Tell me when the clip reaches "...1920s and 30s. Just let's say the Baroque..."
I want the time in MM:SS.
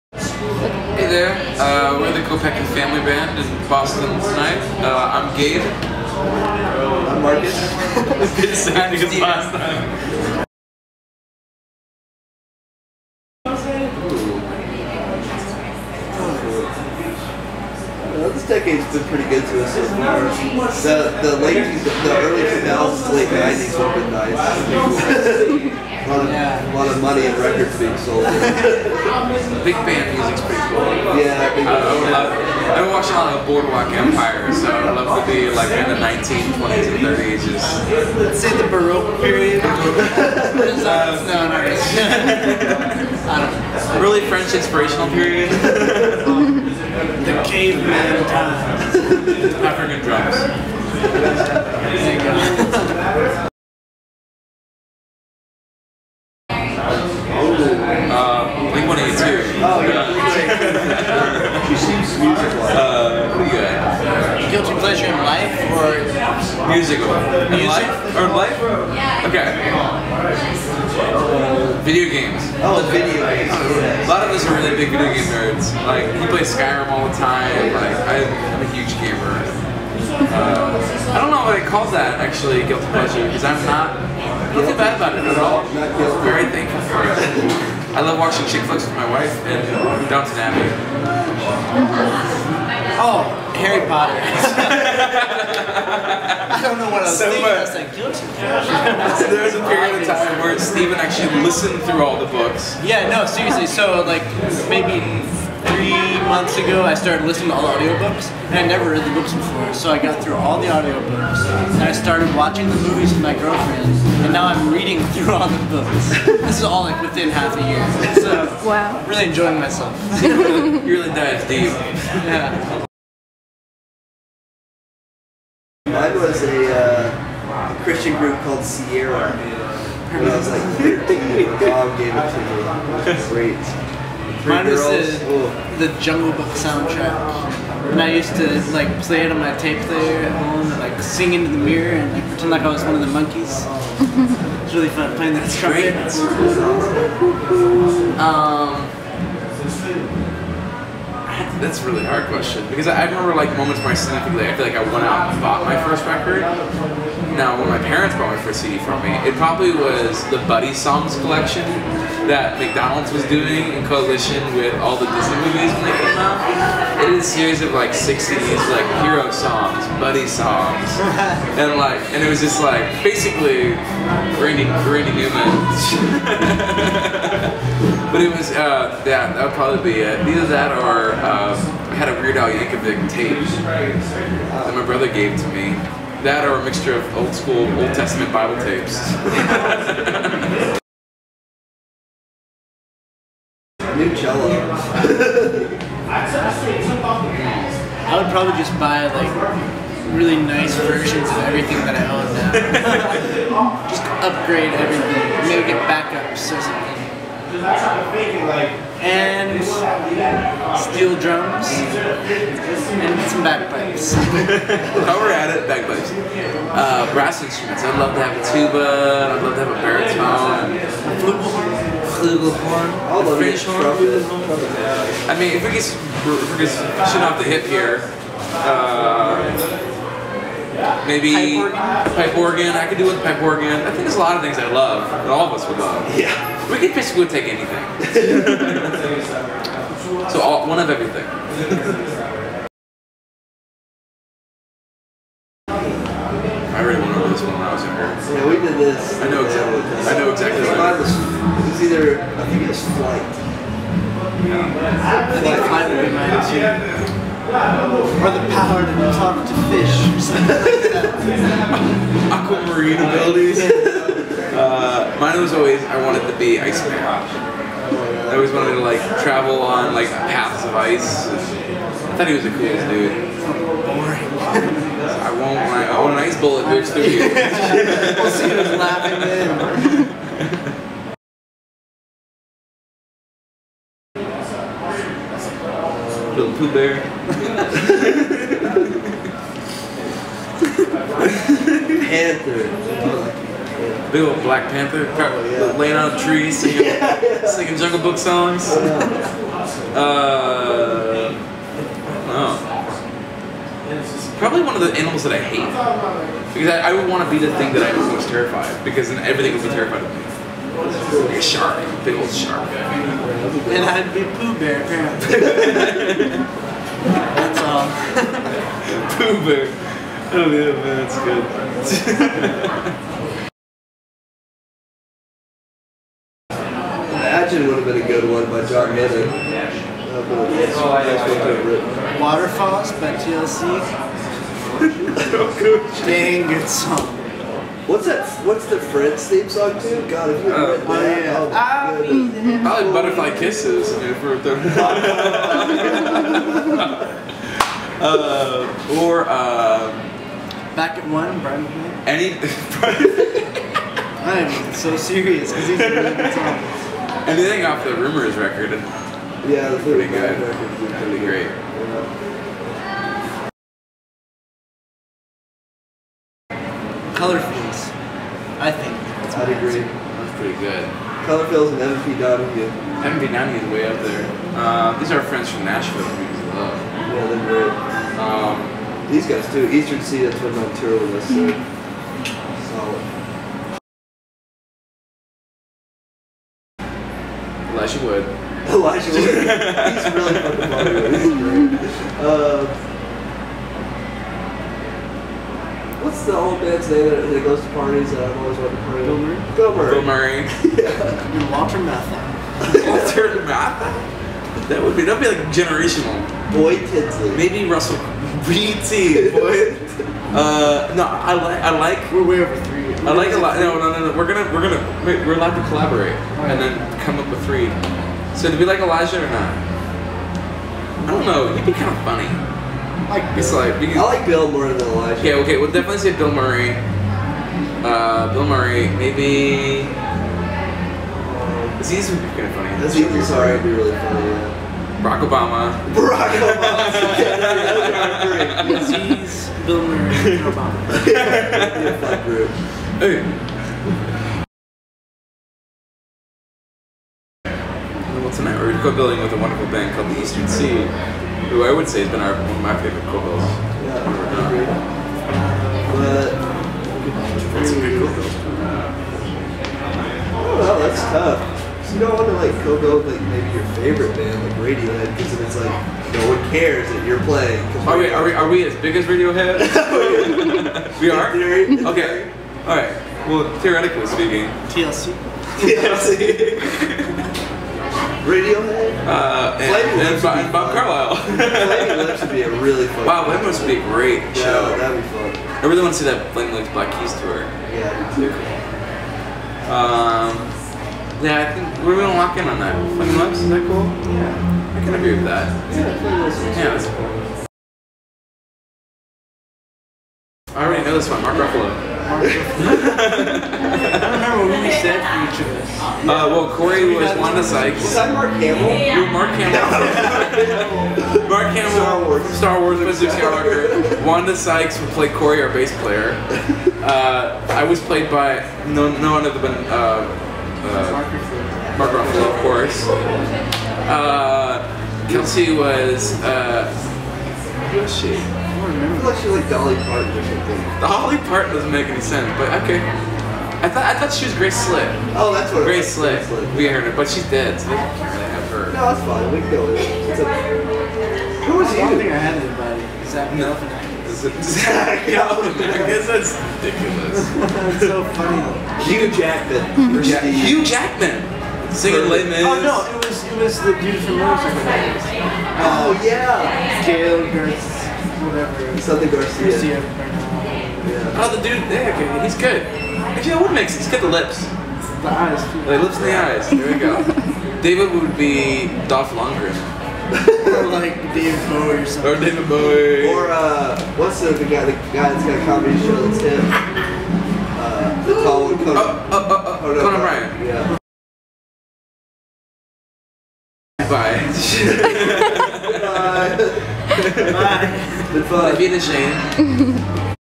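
00:35.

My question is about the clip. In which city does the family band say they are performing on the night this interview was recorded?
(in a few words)
Boston.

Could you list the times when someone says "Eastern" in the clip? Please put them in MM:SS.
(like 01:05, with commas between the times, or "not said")
06:19, 07:30.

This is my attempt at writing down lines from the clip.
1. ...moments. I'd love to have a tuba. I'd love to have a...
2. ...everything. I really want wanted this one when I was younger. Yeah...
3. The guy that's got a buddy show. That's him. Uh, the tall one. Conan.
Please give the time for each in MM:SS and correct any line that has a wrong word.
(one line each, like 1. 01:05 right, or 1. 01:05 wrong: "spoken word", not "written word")
1. 03:37 wrong: "instruments", not "moments"
2. 04:00 right
3. 09:34 wrong: "comedy", not "buddy".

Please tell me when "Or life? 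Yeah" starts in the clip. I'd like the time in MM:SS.
01:08.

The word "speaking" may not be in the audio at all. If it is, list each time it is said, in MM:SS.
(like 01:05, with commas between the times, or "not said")
07:54.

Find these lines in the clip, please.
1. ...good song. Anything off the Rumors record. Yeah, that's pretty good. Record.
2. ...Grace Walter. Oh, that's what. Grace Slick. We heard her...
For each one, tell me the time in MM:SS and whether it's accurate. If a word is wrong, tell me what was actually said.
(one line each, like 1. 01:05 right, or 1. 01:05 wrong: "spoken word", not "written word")
1. 05:56 right
2. 08:54 wrong: "Slick", not "Walter".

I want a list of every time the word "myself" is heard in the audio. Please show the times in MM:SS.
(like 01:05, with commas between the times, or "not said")
01:59.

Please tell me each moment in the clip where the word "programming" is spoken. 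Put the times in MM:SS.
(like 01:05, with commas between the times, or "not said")
not said.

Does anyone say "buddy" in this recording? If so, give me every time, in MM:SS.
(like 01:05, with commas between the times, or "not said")
02:40, 02:50.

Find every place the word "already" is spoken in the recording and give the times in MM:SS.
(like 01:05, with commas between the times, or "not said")
08:20.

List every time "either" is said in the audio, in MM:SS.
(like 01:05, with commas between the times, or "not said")
03:00, 04:11.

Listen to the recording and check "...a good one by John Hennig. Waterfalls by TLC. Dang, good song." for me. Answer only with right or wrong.
right.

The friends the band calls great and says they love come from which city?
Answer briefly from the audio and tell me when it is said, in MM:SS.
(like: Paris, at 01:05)
Nashville, at 06:15.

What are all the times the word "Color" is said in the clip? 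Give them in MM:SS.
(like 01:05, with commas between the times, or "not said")
06:07, 06:11.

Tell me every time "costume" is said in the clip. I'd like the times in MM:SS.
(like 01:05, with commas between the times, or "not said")
not said.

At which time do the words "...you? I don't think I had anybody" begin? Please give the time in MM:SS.
09:01.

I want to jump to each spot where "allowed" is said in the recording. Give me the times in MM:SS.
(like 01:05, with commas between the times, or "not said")
06:55.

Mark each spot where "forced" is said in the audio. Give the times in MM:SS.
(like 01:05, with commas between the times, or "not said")
not said.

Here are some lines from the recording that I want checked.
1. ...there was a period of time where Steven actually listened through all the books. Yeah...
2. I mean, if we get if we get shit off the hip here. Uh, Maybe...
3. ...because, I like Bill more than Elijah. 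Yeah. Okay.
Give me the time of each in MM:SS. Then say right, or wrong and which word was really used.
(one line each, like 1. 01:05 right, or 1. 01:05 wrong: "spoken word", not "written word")
1. 01:39 right
2. 03:45 right
3. 07:03 right.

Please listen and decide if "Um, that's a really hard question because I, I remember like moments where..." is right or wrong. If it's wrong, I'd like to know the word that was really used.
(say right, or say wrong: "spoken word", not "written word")
right.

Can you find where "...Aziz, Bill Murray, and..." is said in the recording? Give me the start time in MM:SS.
07:18.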